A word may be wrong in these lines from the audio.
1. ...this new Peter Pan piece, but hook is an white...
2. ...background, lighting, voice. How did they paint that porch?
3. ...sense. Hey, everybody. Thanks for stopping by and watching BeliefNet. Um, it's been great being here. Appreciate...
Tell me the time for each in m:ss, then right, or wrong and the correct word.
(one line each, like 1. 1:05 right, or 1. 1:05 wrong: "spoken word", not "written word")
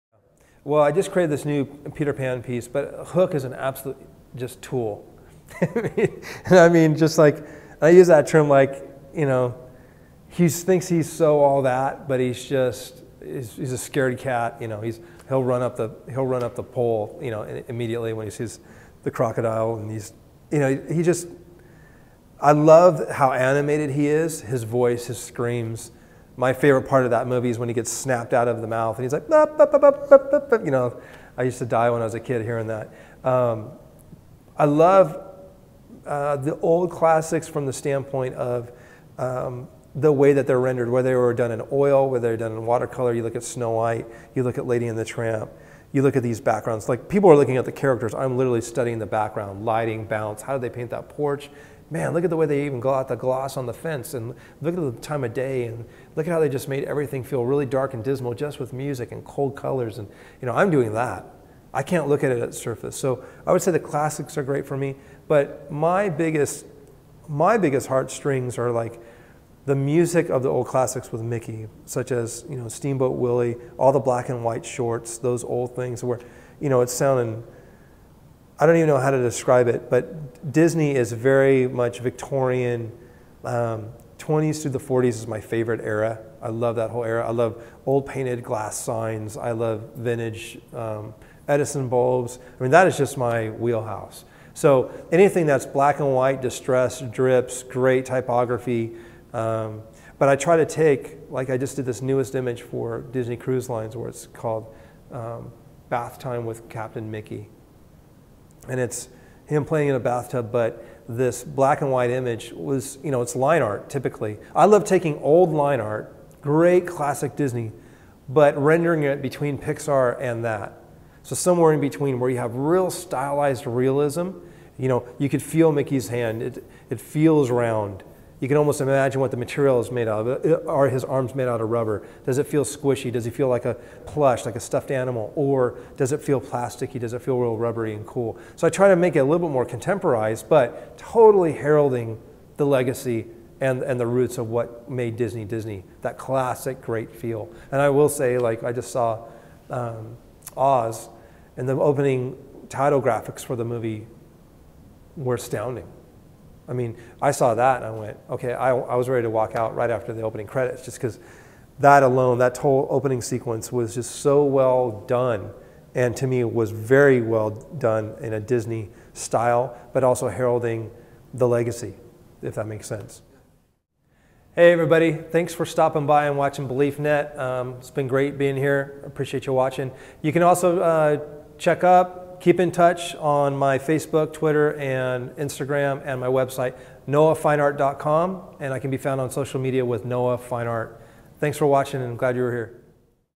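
1. 0:01 wrong: "absolute", not "white"
2. 0:49 wrong: "bounce", not "voice"
3. 2:52 right.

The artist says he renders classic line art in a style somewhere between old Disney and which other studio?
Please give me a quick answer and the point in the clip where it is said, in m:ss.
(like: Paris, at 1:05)
Pixar, at 1:59.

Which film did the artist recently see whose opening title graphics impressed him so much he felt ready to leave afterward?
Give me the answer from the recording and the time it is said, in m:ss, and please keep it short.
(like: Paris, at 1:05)
Oz, at 2:30.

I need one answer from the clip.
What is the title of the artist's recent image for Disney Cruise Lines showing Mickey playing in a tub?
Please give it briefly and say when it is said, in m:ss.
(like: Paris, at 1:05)
Bath Time with Captain Mickey, at 1:45.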